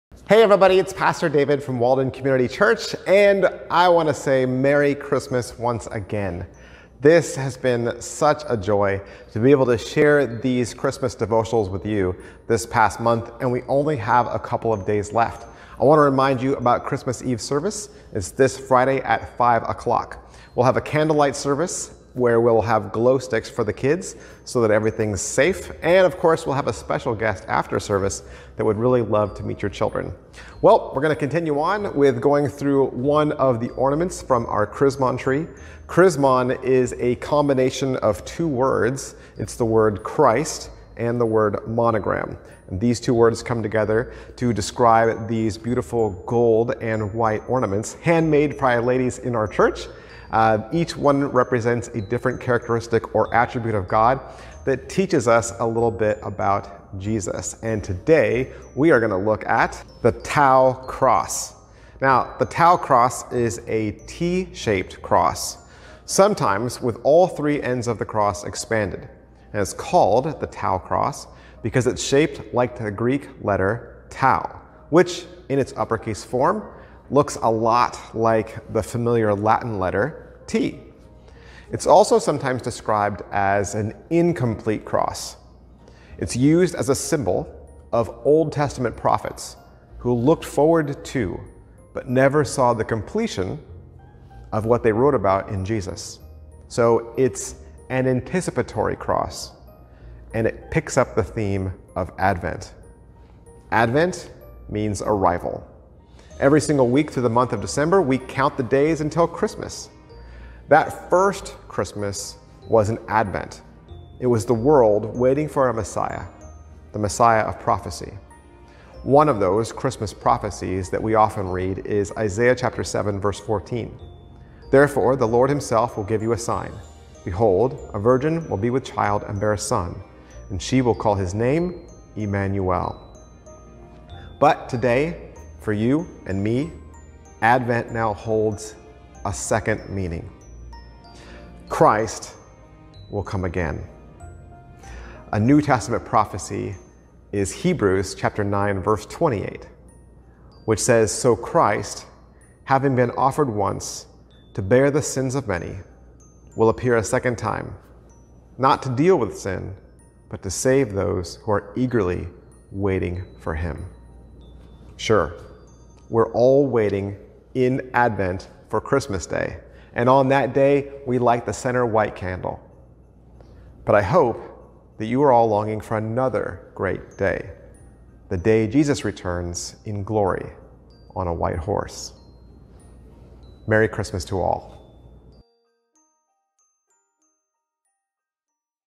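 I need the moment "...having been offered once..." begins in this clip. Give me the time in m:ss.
2:32.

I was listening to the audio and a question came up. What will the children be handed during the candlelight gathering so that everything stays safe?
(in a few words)
Glow sticks.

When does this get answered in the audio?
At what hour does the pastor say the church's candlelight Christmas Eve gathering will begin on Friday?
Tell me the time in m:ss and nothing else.
0:19.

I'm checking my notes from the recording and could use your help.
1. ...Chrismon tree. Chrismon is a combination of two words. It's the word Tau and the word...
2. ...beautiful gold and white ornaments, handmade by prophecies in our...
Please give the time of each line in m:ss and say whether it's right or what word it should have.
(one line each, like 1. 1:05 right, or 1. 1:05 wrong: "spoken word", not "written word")
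1. 0:34 wrong: "Christ", not "Tau"
2. 0:45 wrong: "ladies", not "prophecies".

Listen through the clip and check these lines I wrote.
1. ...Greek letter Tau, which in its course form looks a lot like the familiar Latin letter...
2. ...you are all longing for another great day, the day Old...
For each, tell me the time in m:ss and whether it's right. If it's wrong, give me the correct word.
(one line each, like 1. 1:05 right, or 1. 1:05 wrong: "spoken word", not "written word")
1. 1:12 wrong: "uppercase", not "course"
2. 2:55 wrong: "Jesus", not "Old".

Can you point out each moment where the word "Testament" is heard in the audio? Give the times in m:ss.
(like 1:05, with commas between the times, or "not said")
1:28, 2:25.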